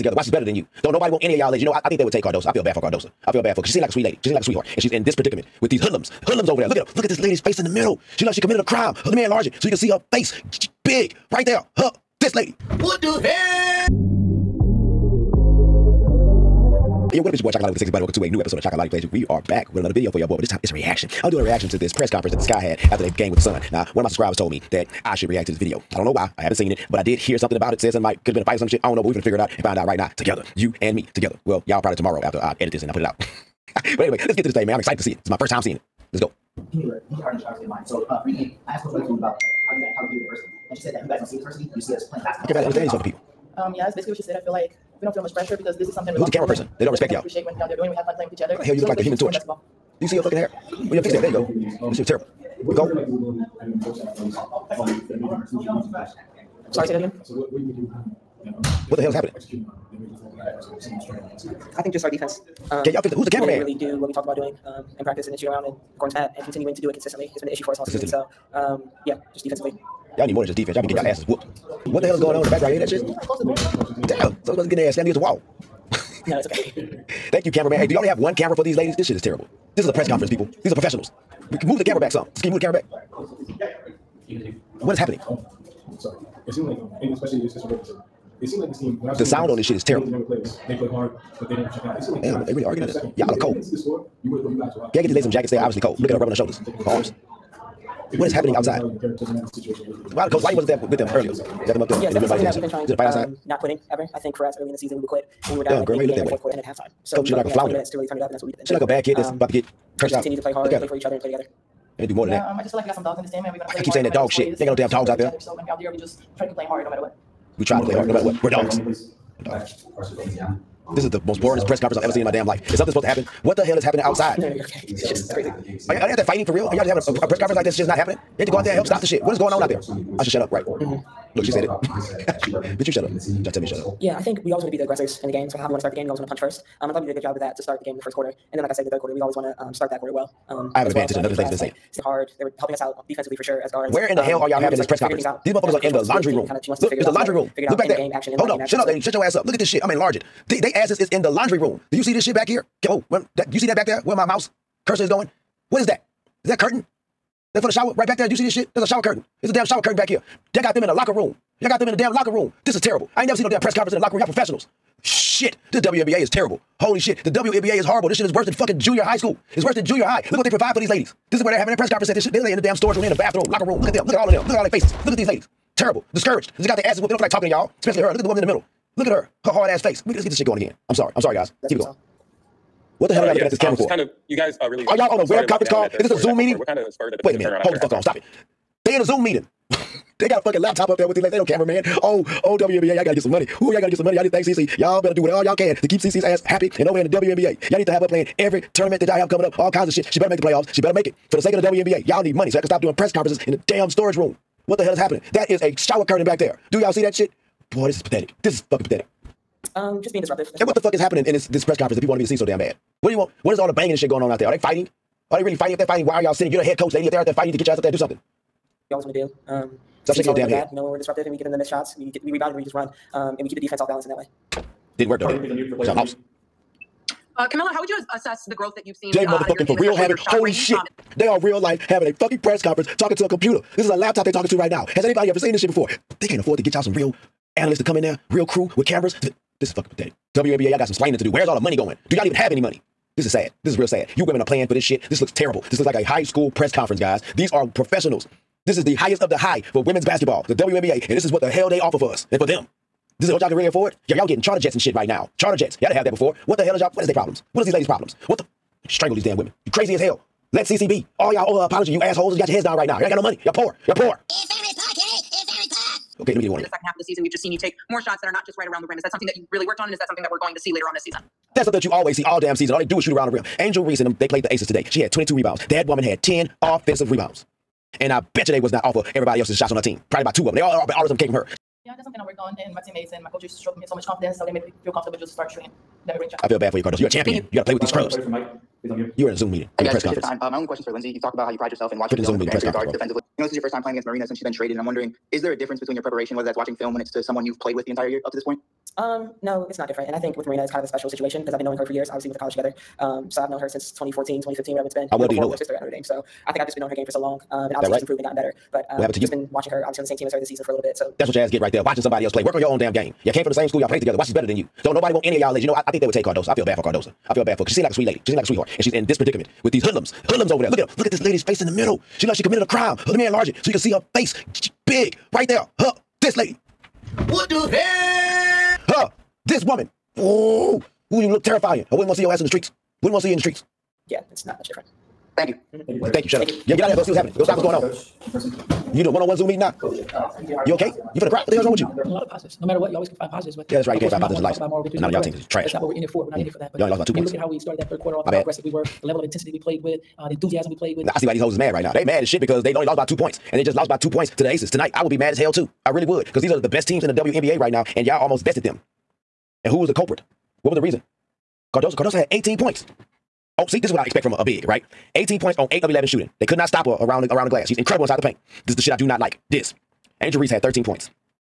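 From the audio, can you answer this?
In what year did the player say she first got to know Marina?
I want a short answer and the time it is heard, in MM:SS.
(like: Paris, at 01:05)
2014, at 05:03.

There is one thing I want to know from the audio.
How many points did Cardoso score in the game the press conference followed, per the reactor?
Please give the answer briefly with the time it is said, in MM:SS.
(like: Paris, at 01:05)
18, at 06:01.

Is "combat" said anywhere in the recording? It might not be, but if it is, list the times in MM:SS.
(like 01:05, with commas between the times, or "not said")
not said.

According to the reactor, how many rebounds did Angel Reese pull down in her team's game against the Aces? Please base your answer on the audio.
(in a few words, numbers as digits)
22.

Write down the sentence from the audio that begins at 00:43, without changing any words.
Um, yeah, it's basically what she said.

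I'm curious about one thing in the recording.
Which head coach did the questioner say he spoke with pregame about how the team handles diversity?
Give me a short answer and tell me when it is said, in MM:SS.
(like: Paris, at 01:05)
Coach Weatherspoon, at 00:38.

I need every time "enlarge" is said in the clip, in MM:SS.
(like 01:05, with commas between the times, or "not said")
00:09, 02:29, 05:23.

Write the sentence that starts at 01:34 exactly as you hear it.
Can I get these ladies some jackets?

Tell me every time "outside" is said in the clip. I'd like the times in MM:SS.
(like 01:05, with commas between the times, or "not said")
01:38, 01:43, 02:04.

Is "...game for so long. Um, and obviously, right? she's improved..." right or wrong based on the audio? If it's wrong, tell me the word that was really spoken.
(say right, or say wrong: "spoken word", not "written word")
right.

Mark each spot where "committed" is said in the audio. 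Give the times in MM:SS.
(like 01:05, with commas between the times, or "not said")
00:08, 05:22.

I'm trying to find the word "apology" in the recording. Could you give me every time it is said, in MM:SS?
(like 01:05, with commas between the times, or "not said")
04:21.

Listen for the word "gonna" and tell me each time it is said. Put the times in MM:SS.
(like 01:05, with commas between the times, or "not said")
00:29, 01:53, 02:29.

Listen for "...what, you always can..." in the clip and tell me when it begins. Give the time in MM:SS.
05:42.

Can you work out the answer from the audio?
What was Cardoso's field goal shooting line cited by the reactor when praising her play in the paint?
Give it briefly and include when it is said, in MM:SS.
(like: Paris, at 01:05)
8 of 11, at 06:05.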